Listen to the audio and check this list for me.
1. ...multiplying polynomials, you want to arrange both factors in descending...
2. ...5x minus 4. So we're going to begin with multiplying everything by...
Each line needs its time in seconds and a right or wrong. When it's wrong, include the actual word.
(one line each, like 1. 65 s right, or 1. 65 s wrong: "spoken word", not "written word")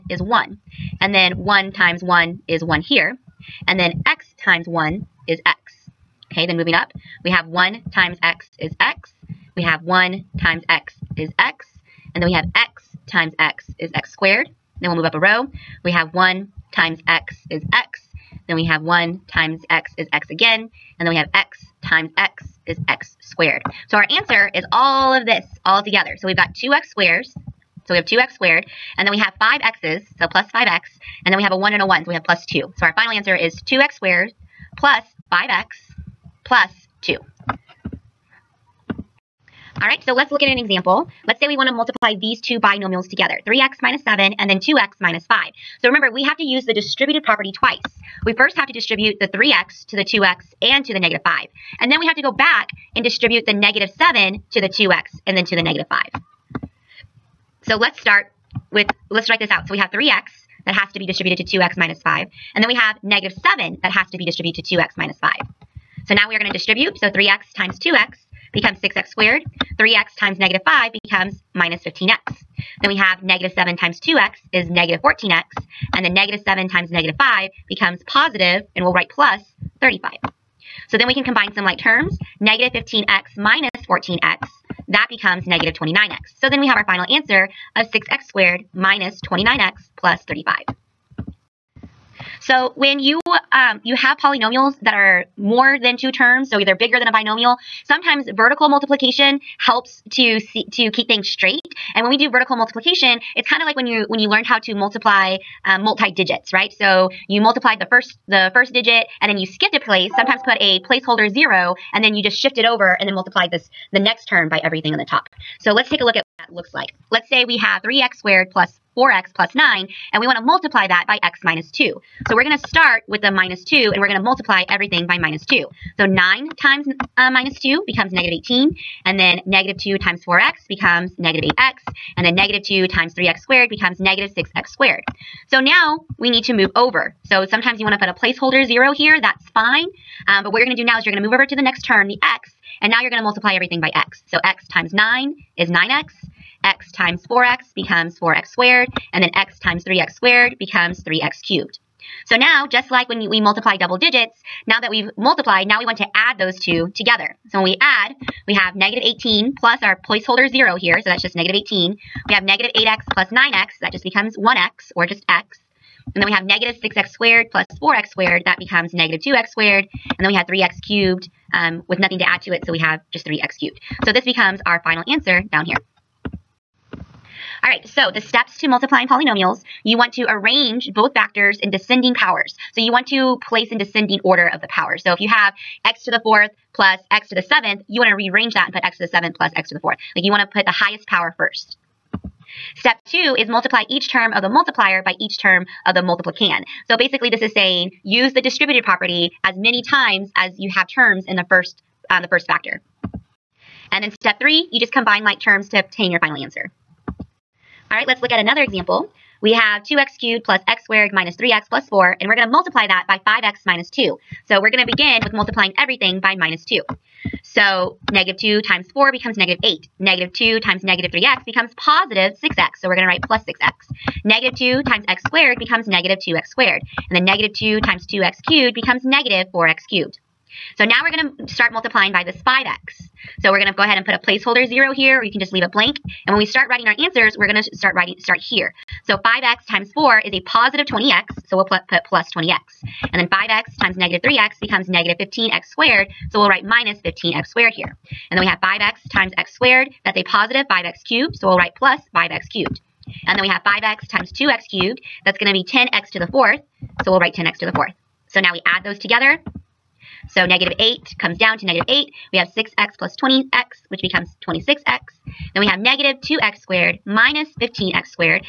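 1. 178 s right
2. 213 s wrong: "2", not "4".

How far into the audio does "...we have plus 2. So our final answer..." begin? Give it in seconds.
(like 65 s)
32 s.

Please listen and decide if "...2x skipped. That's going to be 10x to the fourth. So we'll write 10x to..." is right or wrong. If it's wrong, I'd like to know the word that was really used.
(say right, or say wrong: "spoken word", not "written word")
wrong: "cubed", not "skipped".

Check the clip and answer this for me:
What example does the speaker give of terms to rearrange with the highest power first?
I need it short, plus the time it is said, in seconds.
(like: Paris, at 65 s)
x^4 + x^7, at 185 s.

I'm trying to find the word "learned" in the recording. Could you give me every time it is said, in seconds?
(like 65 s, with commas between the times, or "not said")
104 s.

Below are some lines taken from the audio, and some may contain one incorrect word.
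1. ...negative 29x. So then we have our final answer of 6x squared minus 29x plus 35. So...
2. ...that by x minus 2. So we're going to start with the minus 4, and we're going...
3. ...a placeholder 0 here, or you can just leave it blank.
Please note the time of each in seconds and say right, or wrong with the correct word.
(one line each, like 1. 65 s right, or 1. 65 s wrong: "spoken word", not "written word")
1. 85 s right
2. 120 s wrong: "2", not "4"
3. 234 s right.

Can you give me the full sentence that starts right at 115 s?
So let's take a look at what that looks like.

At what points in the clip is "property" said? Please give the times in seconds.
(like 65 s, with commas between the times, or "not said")
47 s, 198 s.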